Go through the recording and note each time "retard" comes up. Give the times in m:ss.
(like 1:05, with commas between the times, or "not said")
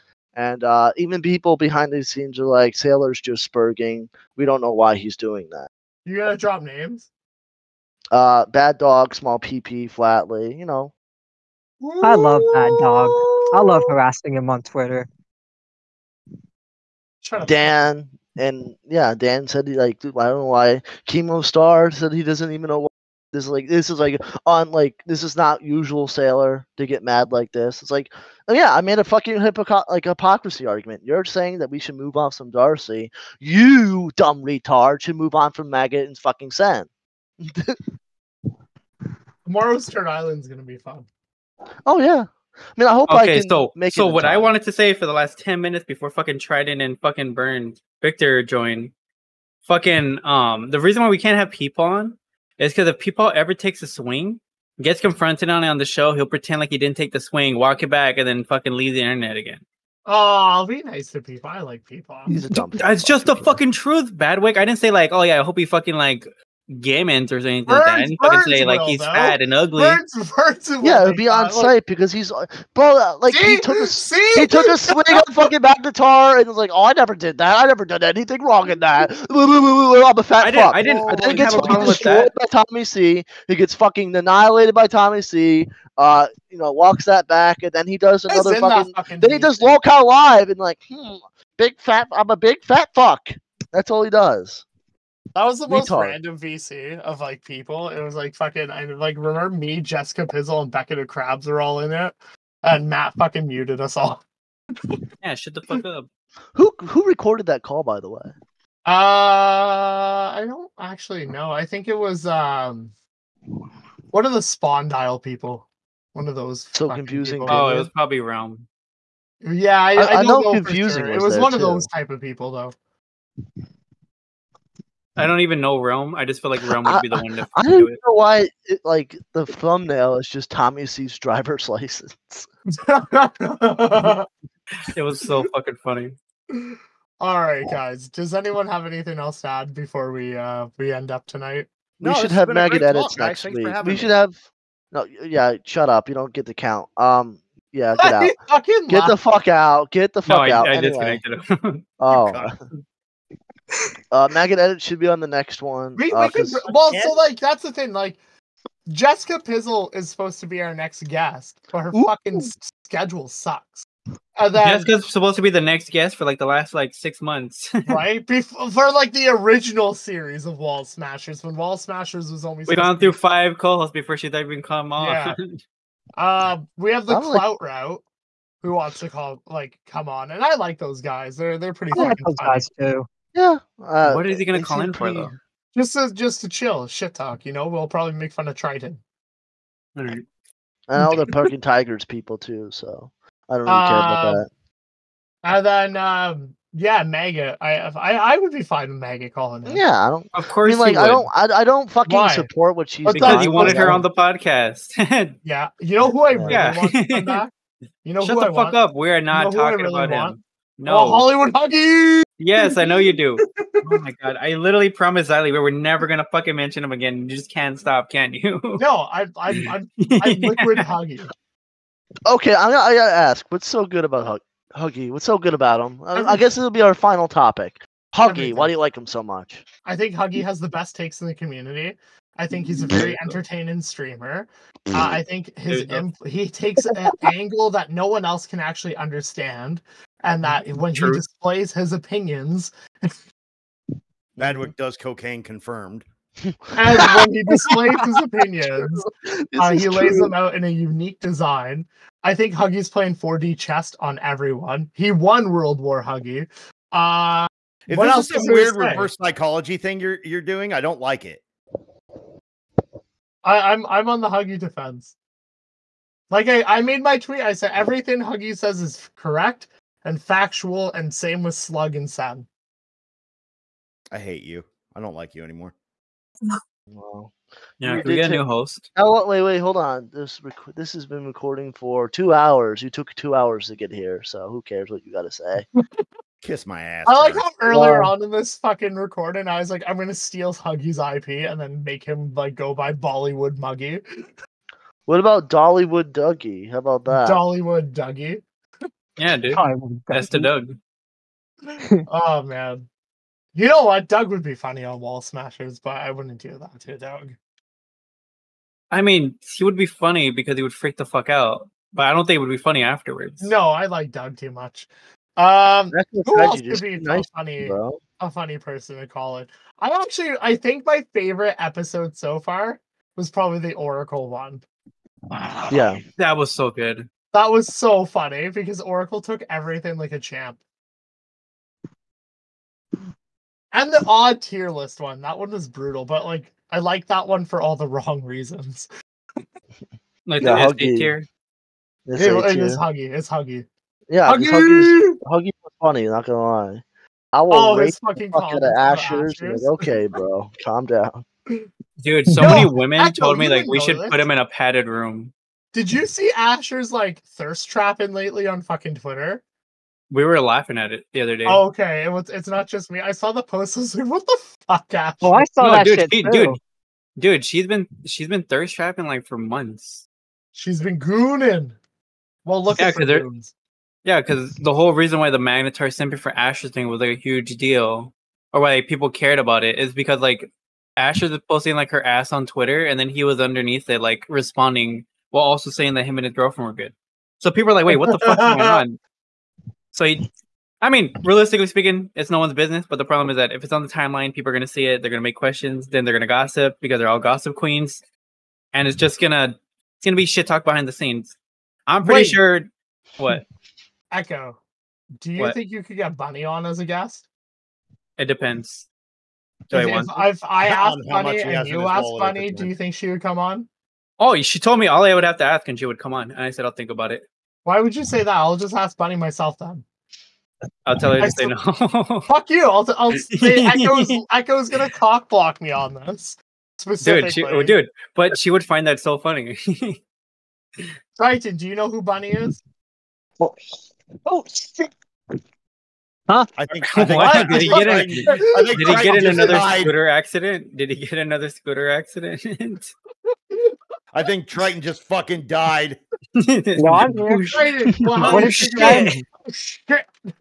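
0:34, 1:35.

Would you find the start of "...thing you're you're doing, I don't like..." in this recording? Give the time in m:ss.
4:19.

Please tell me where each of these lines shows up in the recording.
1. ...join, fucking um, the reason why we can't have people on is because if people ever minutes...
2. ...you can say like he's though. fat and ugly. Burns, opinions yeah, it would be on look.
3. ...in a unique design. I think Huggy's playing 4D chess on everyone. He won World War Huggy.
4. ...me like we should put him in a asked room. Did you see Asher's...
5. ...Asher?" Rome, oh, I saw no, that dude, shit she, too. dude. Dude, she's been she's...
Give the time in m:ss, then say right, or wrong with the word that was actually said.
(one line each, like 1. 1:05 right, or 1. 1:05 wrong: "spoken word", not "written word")
1. 0:48 wrong: "takes", not "minutes"
2. 1:08 wrong: "burns", not "opinions"
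3. 4:10 right
4. 5:53 wrong: "padded", not "asked"
5. 6:04 wrong: "Well", not "Rome".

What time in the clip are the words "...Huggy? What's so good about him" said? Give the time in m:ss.
3:44.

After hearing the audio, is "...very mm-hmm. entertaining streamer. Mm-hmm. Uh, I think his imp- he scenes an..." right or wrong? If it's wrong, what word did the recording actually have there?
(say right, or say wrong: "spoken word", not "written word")
wrong: "takes", not "scenes".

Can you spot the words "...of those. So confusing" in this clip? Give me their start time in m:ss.
1:56.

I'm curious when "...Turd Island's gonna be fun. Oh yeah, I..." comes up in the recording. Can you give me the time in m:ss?
0:39.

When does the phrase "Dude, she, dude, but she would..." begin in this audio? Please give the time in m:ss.
7:07.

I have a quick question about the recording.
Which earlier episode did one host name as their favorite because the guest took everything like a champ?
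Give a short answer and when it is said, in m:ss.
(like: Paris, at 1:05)
The Oracle one, at 5:23.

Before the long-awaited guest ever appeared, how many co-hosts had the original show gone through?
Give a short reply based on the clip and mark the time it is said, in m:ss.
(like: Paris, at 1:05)
5, at 2:53.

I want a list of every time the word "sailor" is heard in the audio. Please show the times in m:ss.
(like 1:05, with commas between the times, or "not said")
0:02, 0:26.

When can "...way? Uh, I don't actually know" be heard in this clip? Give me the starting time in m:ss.
1:48.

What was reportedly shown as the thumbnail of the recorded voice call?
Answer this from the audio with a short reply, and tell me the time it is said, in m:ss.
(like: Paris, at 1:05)
Tommy C's driver's license, at 2:10.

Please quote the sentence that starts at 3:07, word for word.
You know, we'll probably make fun of Triton.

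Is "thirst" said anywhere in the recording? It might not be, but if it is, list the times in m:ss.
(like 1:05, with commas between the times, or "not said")
5:57, 6:08.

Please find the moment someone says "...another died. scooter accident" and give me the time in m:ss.
7:19.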